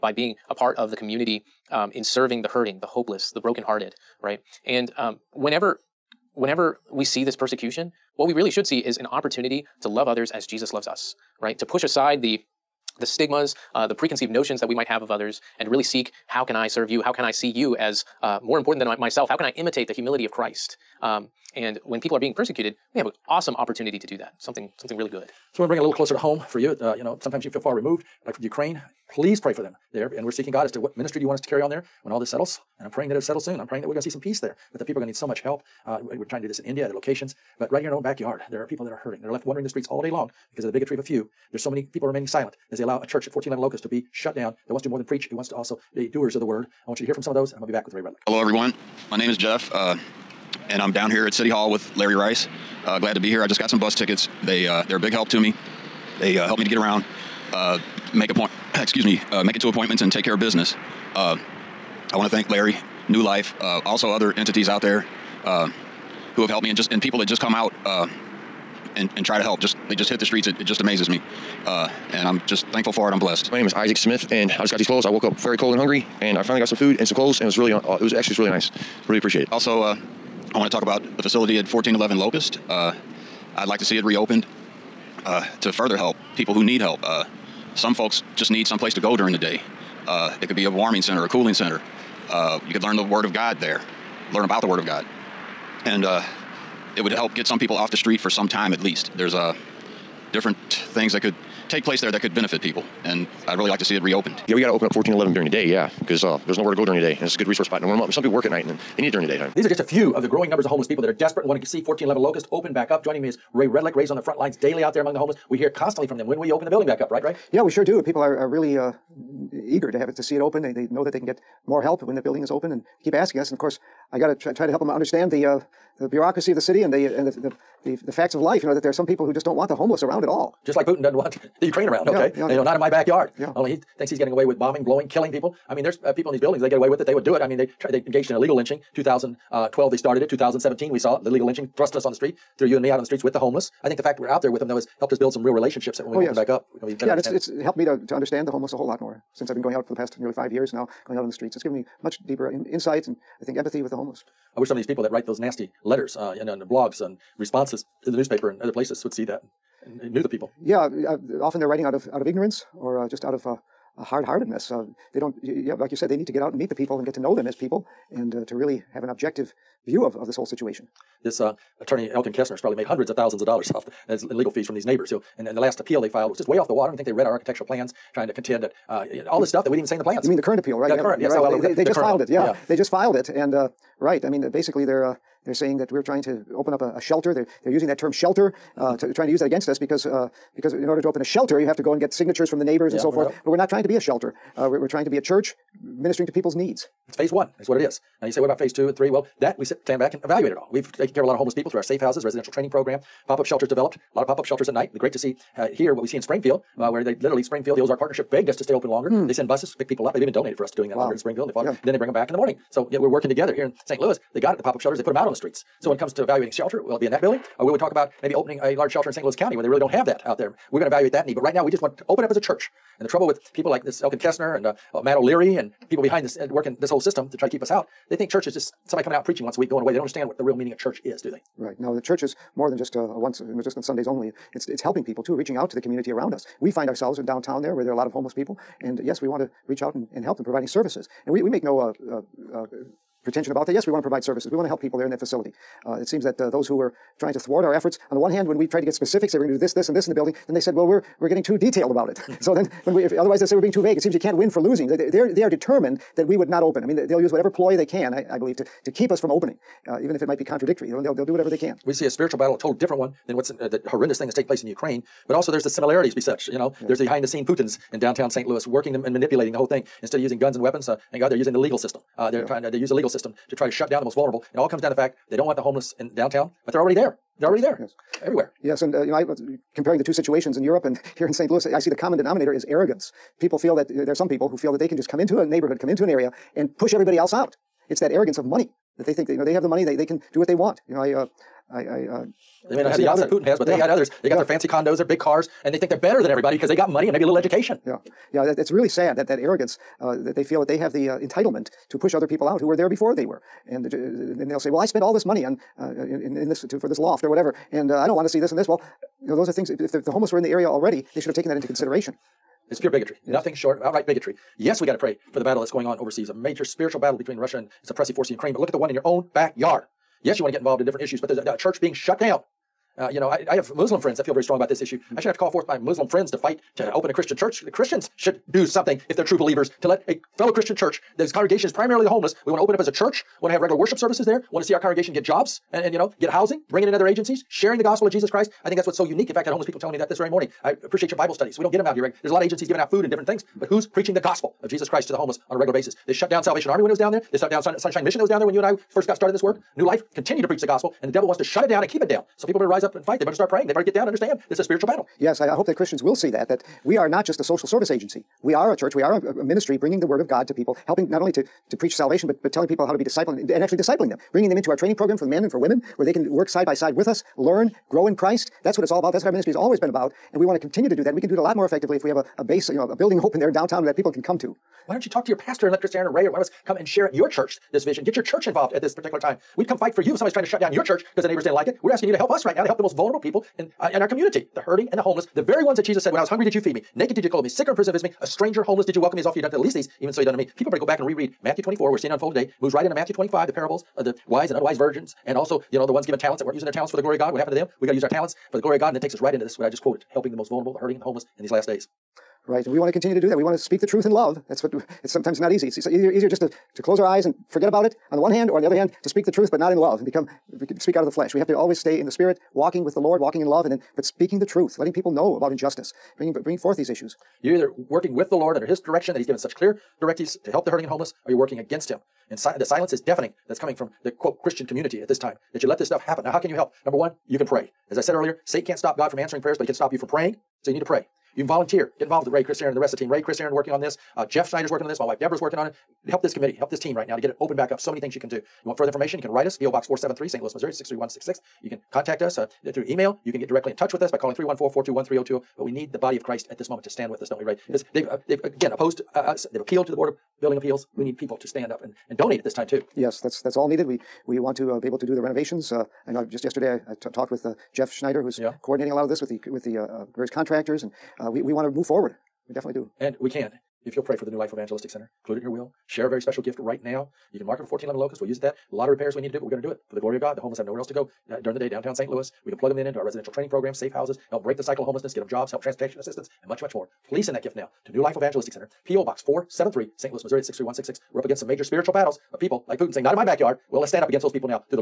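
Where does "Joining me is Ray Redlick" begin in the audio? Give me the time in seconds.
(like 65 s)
113 s.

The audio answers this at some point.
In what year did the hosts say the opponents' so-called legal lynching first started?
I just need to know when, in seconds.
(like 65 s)
138 s.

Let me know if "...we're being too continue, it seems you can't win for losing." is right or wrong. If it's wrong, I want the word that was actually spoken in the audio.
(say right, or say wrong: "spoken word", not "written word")
wrong: "vague", not "continue".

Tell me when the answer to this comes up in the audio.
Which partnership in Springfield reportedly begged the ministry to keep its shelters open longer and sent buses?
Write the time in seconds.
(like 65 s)
207 s.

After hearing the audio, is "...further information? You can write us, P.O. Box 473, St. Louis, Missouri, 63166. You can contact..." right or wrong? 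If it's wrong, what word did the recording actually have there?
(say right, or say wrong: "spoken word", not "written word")
right.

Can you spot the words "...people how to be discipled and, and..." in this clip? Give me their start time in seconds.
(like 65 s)
362 s.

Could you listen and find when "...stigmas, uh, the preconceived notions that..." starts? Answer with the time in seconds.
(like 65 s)
13 s.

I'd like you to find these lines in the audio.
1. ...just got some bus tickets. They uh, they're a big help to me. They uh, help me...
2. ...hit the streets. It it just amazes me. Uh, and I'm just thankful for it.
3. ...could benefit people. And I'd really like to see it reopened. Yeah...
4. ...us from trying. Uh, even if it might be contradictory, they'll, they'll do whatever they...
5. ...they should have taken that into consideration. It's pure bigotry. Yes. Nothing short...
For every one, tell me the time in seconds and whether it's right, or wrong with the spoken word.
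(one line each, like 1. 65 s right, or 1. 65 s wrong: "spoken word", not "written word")
1. 53 s right
2. 70 s right
3. 102 s right
4. 259 s wrong: "opening", not "trying"
5. 311 s right.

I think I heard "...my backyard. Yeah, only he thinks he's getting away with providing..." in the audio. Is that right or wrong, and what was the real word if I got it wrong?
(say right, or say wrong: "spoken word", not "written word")
wrong: "bombing", not "providing".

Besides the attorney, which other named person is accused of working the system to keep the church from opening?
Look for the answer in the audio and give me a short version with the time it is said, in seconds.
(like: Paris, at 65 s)
Matt O'Leary, at 225 s.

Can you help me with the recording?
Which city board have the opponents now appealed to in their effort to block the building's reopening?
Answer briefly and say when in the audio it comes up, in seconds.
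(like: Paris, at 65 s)
Board of building appeals, at 449 s.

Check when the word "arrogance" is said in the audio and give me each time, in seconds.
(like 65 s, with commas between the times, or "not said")
282 s, 288 s, 299 s.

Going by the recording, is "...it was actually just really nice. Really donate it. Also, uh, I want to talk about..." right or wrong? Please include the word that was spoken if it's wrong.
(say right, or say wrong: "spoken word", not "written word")
wrong: "appreciate", not "donate".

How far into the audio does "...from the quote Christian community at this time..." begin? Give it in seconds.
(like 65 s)
423 s.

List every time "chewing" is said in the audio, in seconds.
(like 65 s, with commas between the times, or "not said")
not said.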